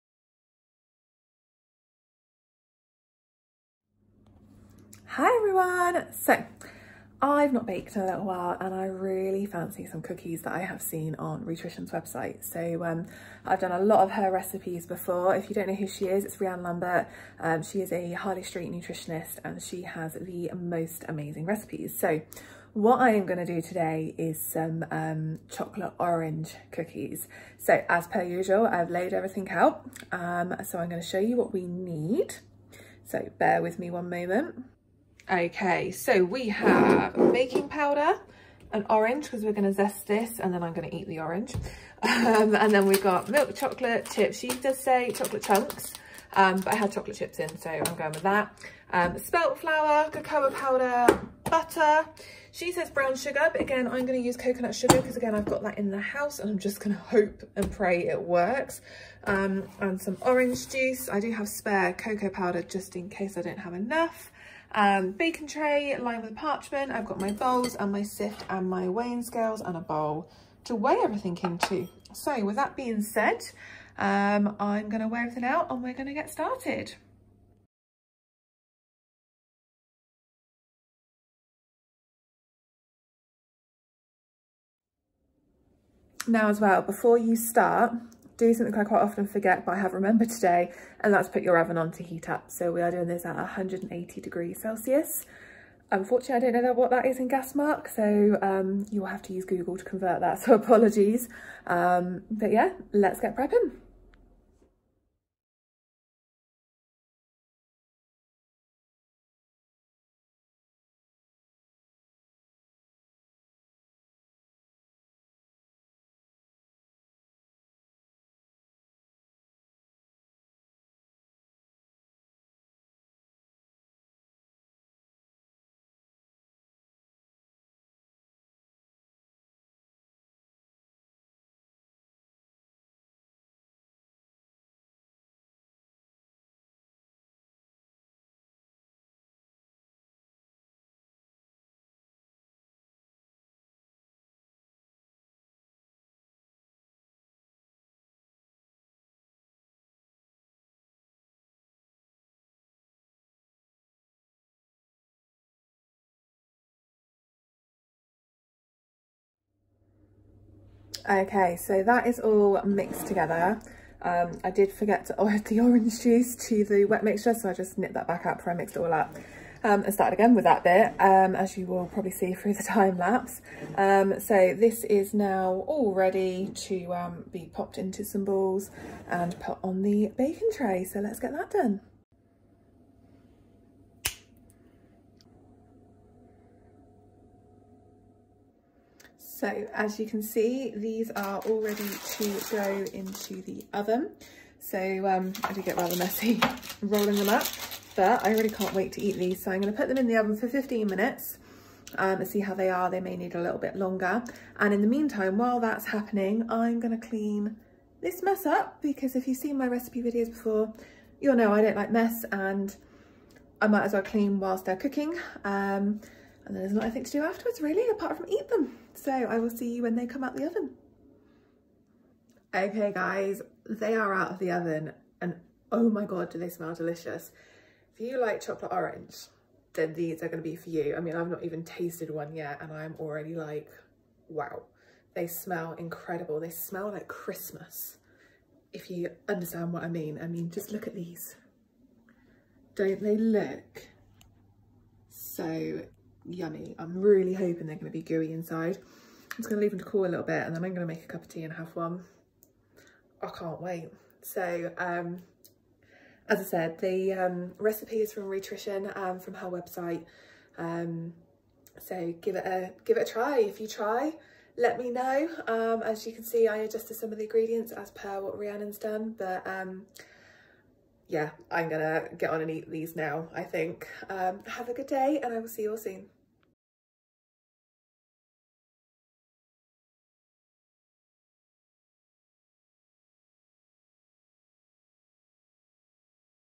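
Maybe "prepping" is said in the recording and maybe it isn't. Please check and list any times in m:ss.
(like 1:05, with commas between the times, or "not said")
1:43.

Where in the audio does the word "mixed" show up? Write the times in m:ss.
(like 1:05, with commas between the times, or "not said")
2:42, 2:48.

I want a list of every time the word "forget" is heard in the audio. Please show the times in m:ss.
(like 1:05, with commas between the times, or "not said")
1:29, 2:44.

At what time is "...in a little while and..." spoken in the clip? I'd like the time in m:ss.
0:07.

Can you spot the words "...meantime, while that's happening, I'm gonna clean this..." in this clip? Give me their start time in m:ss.
3:24.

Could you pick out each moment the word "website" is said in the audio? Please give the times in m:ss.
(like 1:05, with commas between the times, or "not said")
0:11, 4:19.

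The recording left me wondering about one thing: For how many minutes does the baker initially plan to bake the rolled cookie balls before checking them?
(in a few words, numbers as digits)
15 minutes.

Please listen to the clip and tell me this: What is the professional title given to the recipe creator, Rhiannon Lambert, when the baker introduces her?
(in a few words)
Harley Street nutritionist.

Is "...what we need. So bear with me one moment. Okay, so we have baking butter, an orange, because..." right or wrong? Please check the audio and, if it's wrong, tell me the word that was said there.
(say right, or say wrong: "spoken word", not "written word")
wrong: "powder", not "butter".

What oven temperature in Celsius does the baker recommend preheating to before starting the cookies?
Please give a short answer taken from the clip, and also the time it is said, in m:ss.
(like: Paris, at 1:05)
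180 degrees Celsius, at 1:33.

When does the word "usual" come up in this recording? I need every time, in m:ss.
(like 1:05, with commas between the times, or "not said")
0:28.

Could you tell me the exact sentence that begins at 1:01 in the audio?
I do have spare cocoa powder just in case I don't have enough.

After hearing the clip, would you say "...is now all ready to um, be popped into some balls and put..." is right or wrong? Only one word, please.
right.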